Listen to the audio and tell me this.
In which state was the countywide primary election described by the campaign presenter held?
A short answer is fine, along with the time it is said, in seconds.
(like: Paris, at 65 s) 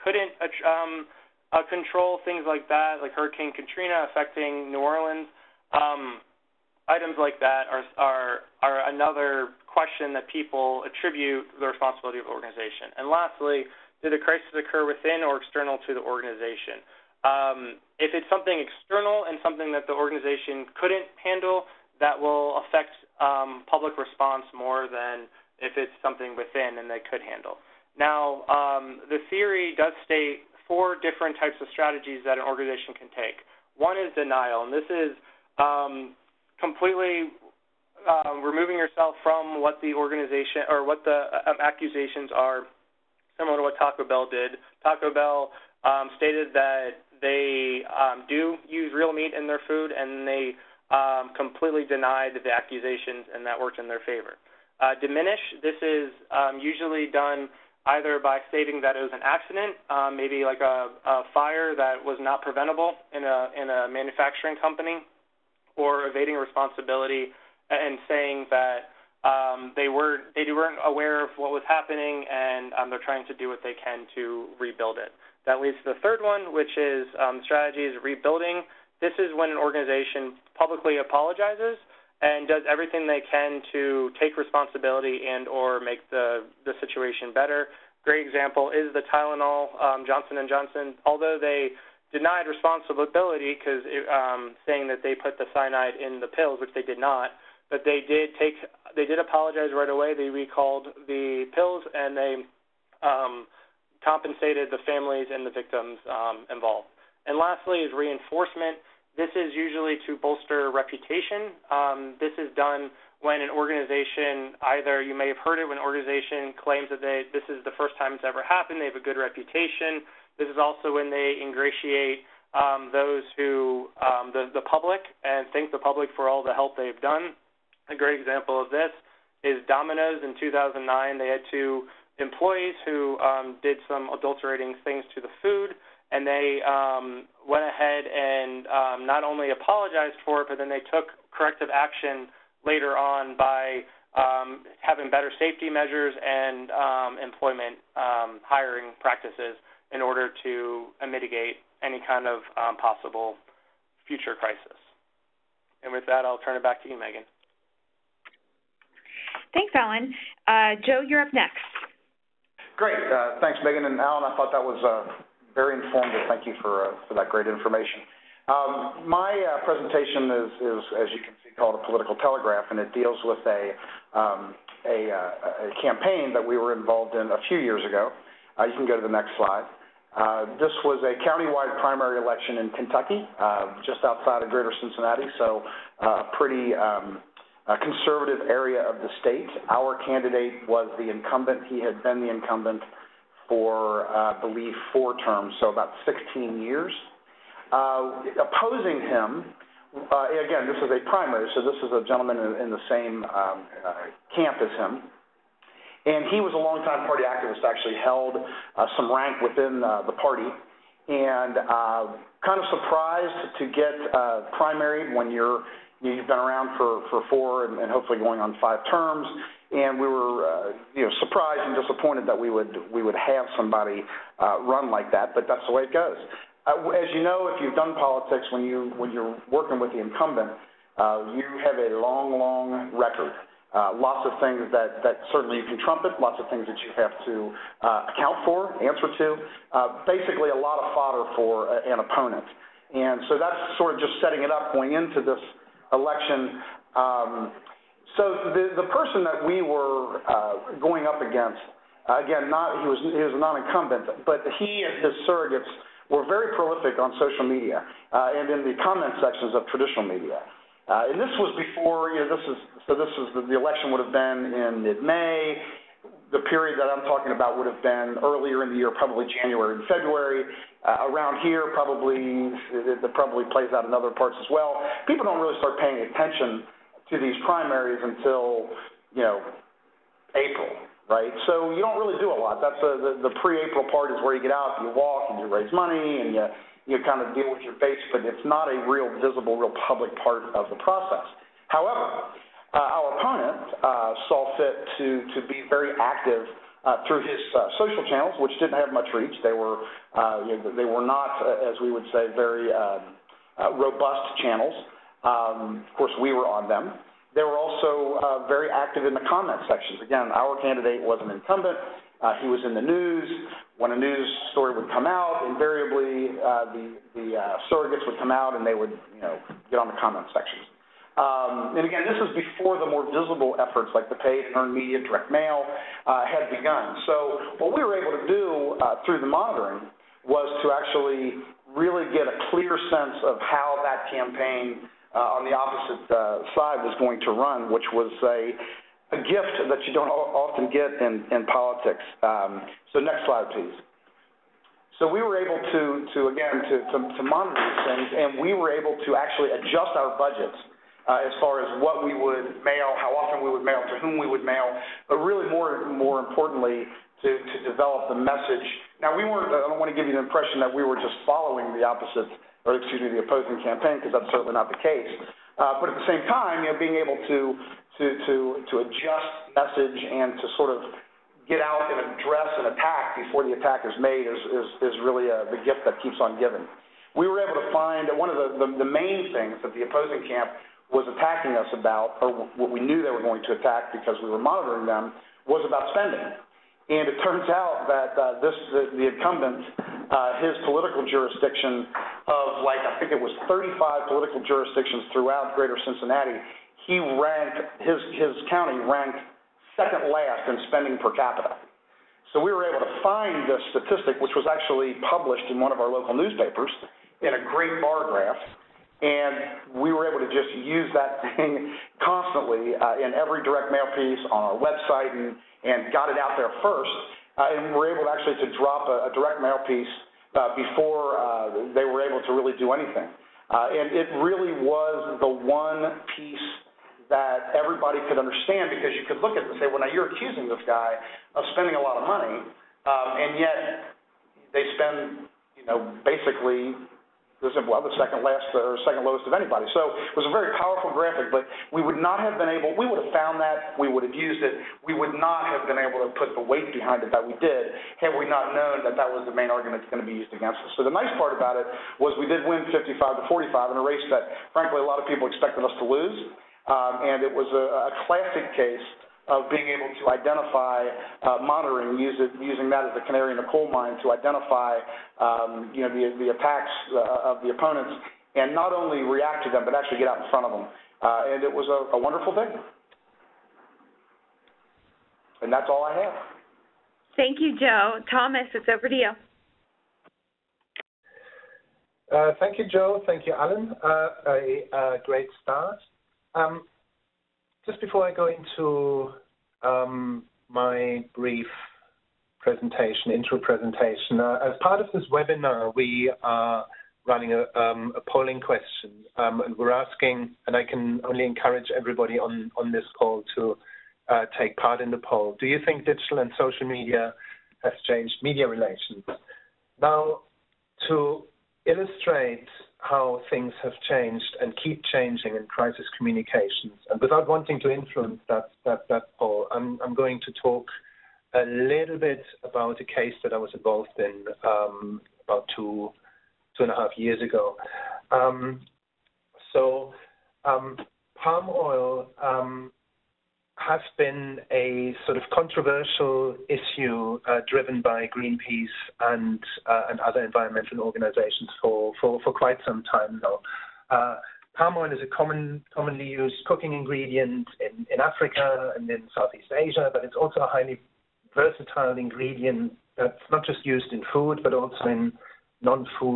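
Kentucky, at 182 s.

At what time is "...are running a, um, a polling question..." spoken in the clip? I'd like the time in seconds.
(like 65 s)
496 s.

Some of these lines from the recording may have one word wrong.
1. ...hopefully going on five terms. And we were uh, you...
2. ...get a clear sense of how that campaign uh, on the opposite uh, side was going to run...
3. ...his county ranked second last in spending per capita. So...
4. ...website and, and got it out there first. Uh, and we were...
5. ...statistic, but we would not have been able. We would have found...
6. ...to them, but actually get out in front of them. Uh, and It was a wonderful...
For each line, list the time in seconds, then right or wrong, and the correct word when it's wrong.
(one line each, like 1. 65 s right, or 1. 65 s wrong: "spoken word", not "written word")
1. 217 s right
2. 332 s right
3. 398 s right
4. 414 s right
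5. 440 s wrong: "graphic", not "statistic"
6. 469 s right.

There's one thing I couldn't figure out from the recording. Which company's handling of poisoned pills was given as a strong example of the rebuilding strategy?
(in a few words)
Johnson and Johnson.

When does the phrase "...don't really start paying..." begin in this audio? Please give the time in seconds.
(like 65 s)
275 s.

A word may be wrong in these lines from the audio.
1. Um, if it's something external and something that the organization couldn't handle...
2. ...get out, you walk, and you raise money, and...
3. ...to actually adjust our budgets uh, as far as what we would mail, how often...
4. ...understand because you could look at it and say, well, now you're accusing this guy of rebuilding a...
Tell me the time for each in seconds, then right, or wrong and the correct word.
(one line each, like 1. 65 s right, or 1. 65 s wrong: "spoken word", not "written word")
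1. 17 s right
2. 284 s right
3. 349 s right
4. 428 s wrong: "spending", not "rebuilding".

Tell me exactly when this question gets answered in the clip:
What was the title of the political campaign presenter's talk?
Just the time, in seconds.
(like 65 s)
171 s.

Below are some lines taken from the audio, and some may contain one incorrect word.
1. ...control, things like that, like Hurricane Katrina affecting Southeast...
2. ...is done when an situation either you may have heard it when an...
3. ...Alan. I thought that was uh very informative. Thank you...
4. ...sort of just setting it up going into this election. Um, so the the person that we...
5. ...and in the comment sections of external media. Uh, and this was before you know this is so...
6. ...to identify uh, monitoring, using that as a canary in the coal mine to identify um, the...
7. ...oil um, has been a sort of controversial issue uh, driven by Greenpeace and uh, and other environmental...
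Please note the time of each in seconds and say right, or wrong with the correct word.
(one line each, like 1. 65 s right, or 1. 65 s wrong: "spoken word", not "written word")
1. 1 s wrong: "New", not "Southeast"
2. 112 s wrong: "organization", not "situation"
3. 163 s right
4. 243 s right
5. 258 s wrong: "traditional", not "external"
6. 459 s right
7. 531 s right.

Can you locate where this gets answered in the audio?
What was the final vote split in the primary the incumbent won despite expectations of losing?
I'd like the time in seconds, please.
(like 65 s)
452 s.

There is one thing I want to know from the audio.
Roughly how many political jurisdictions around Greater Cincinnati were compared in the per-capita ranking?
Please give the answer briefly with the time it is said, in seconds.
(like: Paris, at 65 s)
35, at 393 s.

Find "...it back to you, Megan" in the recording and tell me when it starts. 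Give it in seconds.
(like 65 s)
156 s.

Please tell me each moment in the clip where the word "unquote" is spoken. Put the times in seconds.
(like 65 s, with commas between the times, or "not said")
not said.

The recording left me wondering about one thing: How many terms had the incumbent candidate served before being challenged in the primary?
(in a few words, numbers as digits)
4.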